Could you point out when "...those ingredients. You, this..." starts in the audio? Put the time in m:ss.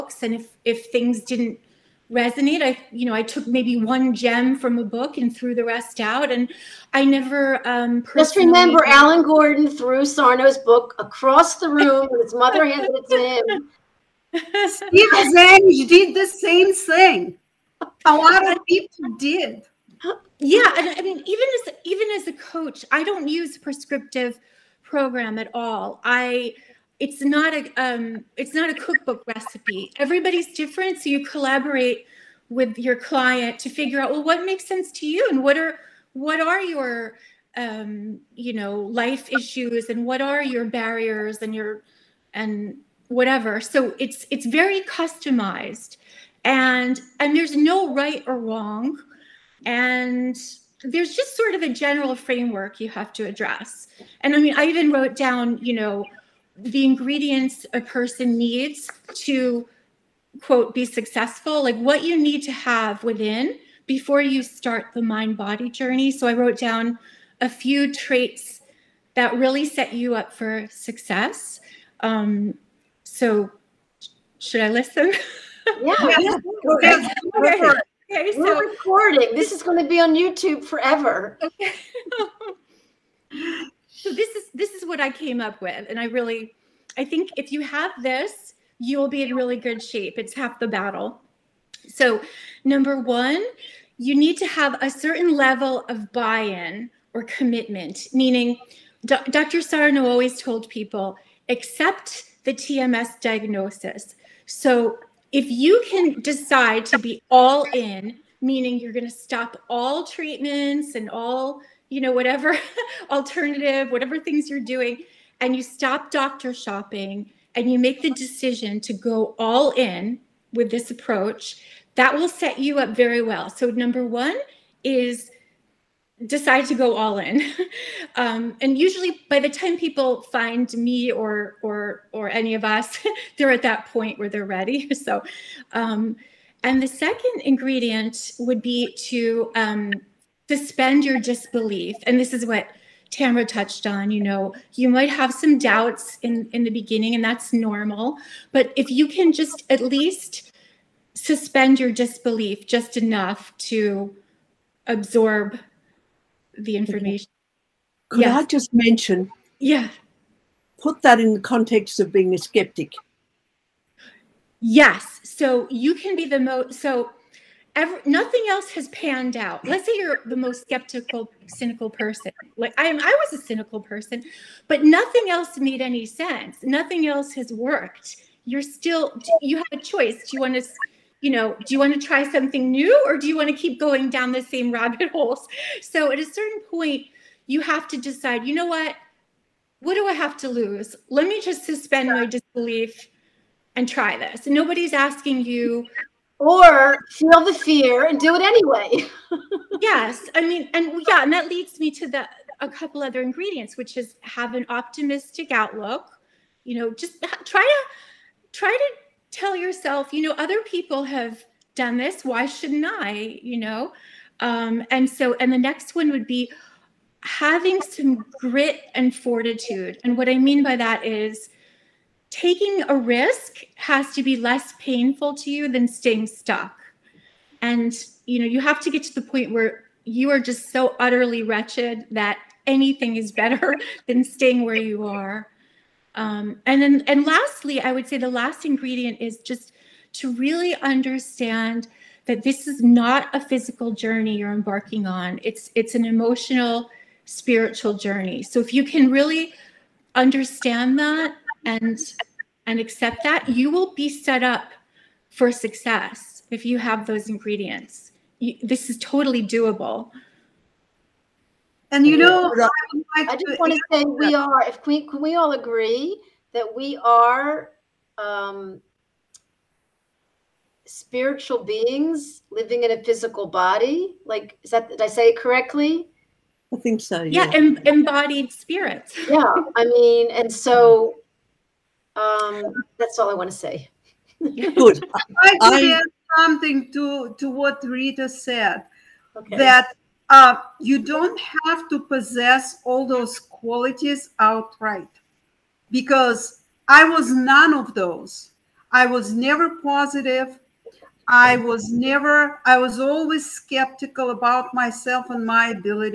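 4:17.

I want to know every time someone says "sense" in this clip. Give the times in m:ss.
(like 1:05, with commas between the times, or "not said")
0:34, 2:56.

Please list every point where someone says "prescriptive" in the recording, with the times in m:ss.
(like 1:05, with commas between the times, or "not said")
0:23.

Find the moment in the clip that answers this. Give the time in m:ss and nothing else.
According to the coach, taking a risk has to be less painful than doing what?
3:45.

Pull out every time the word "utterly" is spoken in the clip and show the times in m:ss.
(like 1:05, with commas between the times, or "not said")
3:50.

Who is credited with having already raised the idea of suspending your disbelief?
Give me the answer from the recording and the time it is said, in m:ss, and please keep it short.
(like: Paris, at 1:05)
Tamara, at 2:23.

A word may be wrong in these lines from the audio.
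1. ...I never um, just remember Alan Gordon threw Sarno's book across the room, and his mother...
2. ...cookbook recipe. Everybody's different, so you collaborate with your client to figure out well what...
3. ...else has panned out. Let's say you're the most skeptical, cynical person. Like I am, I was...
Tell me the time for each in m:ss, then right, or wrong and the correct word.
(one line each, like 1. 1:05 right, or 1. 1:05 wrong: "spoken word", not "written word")
1. 0:06 right
2. 0:28 right
3. 2:48 right.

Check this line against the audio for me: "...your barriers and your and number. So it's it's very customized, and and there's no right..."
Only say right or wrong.
wrong.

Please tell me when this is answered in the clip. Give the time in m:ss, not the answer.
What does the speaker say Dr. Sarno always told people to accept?
1:42.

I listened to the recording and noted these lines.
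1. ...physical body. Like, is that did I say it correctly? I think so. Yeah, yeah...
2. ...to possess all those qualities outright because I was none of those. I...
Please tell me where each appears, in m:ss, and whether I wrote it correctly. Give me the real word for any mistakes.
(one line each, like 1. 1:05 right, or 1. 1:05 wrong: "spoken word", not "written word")
1. 4:33 right
2. 4:51 right.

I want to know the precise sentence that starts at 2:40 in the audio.
Put that in the context of being a skeptic.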